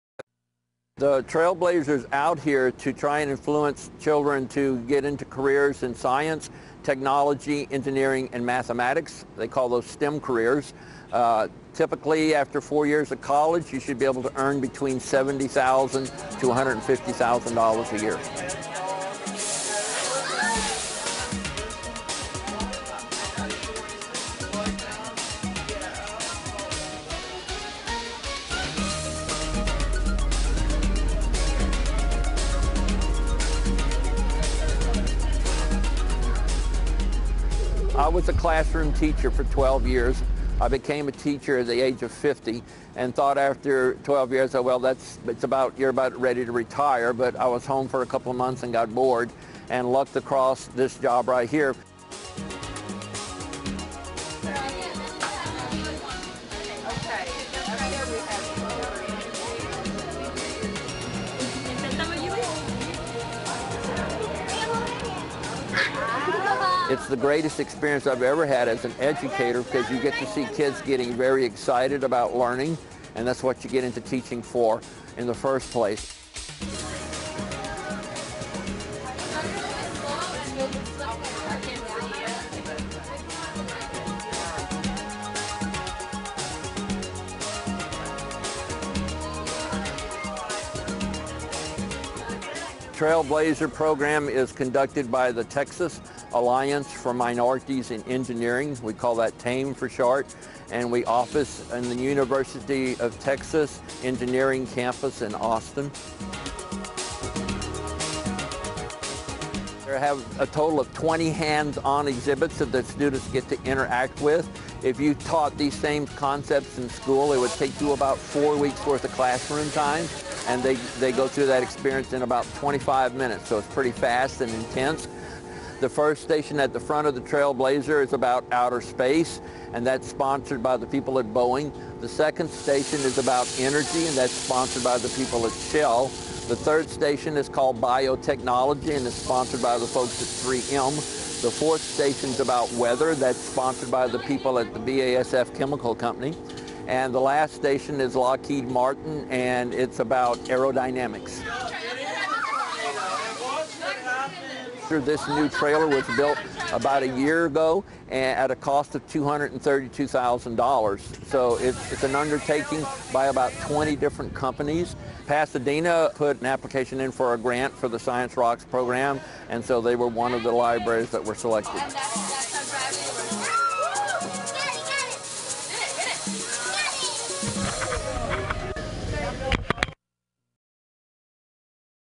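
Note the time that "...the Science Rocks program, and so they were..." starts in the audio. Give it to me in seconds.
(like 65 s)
167 s.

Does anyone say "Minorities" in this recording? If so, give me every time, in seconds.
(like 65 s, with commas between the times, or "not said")
97 s.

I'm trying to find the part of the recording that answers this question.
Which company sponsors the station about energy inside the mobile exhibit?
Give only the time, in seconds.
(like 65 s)
135 s.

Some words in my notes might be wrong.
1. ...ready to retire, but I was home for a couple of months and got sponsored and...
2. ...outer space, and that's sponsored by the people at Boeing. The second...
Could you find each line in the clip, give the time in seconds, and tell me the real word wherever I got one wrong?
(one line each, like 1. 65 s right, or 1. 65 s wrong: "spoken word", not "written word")
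1. 46 s wrong: "bored", not "sponsored"
2. 128 s right.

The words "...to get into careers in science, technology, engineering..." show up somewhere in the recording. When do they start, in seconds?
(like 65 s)
4 s.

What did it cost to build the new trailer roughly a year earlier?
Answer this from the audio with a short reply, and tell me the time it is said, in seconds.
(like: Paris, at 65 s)
$232,000, at 159 s.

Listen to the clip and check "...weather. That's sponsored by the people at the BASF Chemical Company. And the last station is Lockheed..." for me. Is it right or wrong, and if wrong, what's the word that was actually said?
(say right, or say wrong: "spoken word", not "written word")
right.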